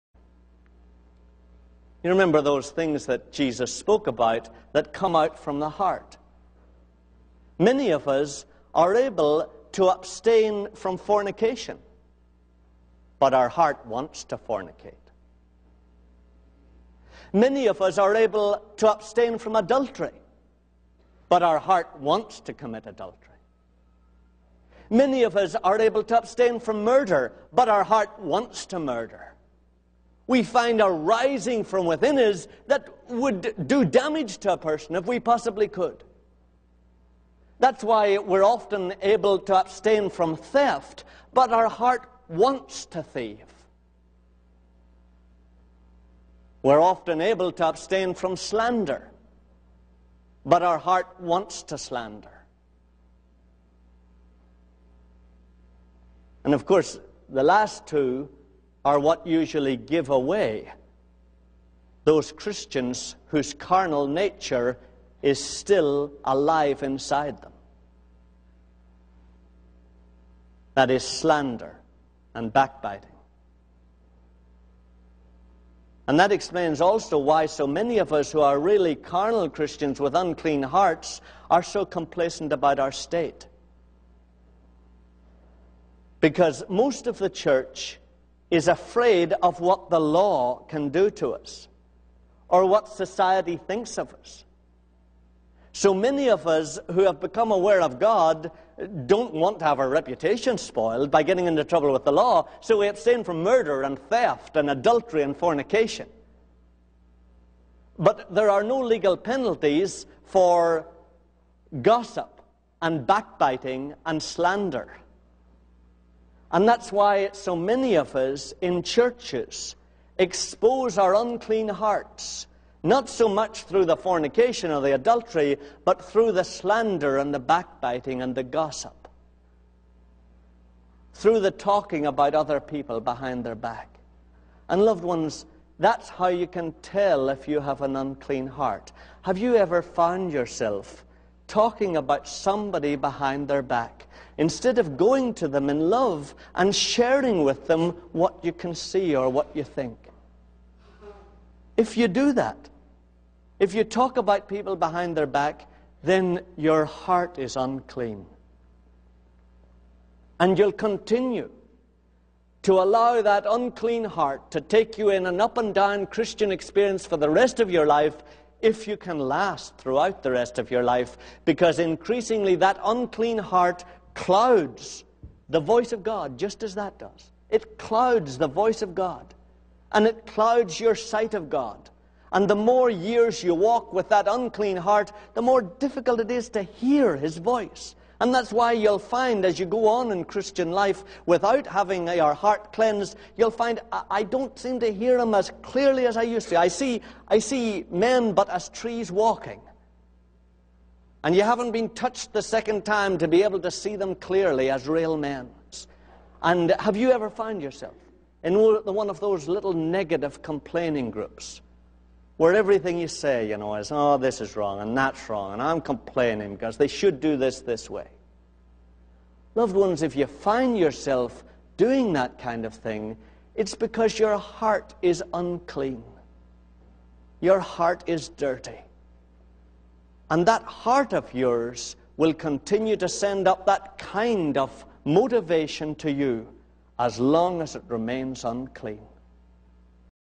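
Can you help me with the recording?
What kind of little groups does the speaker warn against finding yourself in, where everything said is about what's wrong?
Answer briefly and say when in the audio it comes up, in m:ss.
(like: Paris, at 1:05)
negative complaining groups, at 3:29.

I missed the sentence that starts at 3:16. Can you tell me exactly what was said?
I see, I see men but as trees walking.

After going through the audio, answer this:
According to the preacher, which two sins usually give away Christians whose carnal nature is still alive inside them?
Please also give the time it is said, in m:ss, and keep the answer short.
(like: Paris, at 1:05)
slander and backbiting, at 1:11.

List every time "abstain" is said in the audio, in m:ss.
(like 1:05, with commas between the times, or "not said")
0:09, 0:18, 0:26, 0:39, 0:47, 1:42.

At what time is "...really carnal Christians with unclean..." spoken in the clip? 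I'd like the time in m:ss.
1:18.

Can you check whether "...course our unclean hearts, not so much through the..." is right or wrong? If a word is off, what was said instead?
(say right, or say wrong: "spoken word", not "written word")
wrong: "expose", not "course".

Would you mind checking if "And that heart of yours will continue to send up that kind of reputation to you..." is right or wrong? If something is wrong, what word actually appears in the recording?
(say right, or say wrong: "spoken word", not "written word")
wrong: "motivation", not "reputation".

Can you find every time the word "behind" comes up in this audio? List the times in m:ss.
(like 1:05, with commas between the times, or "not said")
2:12, 2:22, 2:34.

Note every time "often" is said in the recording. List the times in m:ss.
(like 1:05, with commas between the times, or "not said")
0:38, 0:46.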